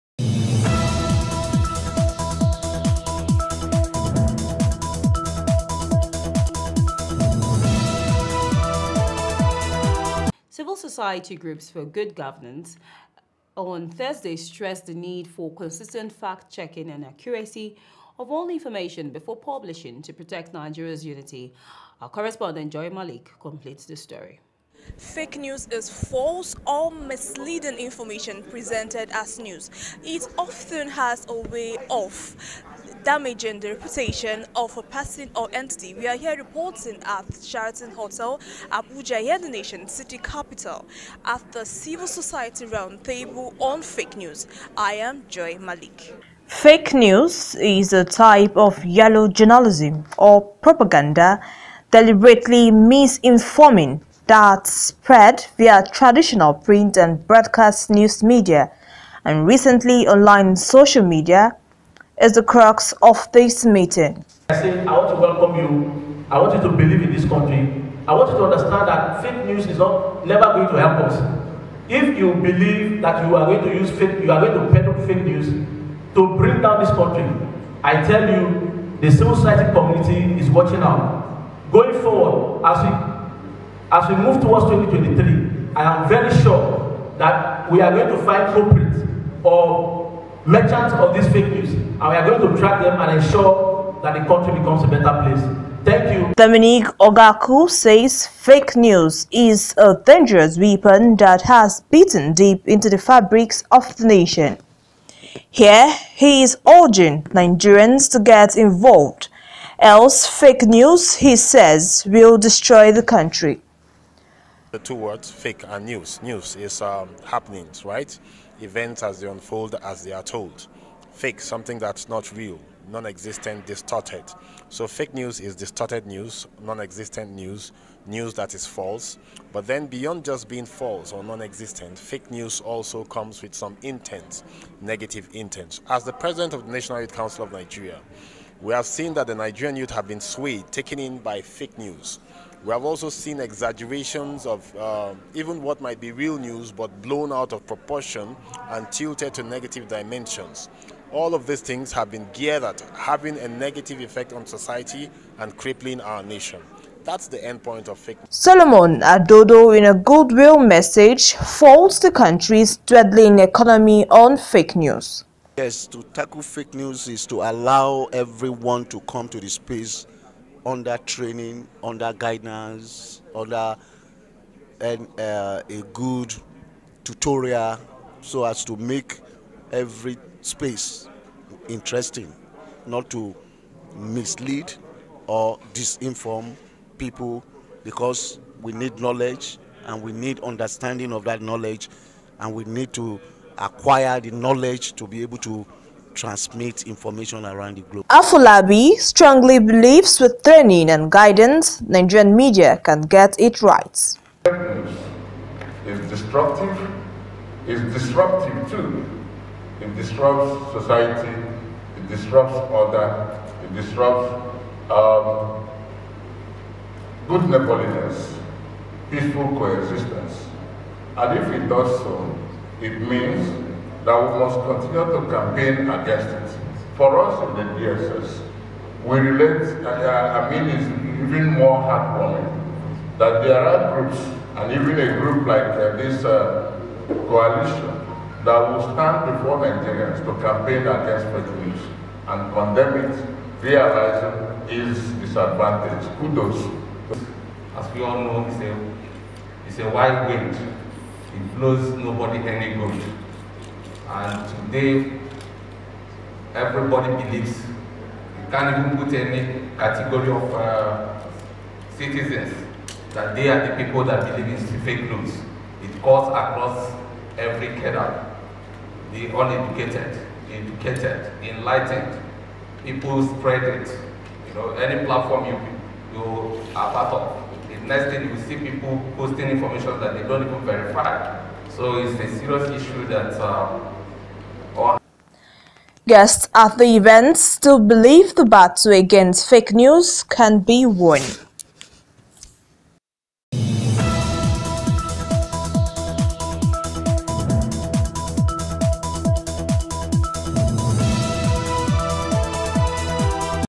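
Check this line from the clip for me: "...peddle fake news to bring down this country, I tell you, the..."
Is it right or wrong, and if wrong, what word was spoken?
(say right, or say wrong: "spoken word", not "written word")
right.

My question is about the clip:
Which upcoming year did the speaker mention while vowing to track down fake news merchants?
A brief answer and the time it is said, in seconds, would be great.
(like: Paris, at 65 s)
2023, at 84 s.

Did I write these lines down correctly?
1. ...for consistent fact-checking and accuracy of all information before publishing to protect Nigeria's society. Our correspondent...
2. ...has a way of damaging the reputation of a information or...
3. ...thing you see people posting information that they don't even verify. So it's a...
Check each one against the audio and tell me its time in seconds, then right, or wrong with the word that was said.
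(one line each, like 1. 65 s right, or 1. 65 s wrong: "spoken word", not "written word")
1. 15 s wrong: "unity", not "society"
2. 30 s wrong: "person", not "information"
3. 278 s right.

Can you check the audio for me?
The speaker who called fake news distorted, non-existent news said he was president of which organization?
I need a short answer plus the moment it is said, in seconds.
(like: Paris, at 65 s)
National Youth Council of Nigeria, at 136 s.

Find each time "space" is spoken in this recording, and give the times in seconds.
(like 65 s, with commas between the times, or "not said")
169 s, 180 s.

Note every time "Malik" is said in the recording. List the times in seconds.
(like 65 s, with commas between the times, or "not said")
22 s, 45 s.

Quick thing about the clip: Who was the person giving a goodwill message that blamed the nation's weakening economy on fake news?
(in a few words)
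Solomon Adodo.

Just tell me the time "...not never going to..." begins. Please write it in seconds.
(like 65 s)
69 s.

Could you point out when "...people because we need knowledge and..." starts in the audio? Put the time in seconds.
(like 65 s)
186 s.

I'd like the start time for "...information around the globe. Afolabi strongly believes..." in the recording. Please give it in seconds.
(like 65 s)
196 s.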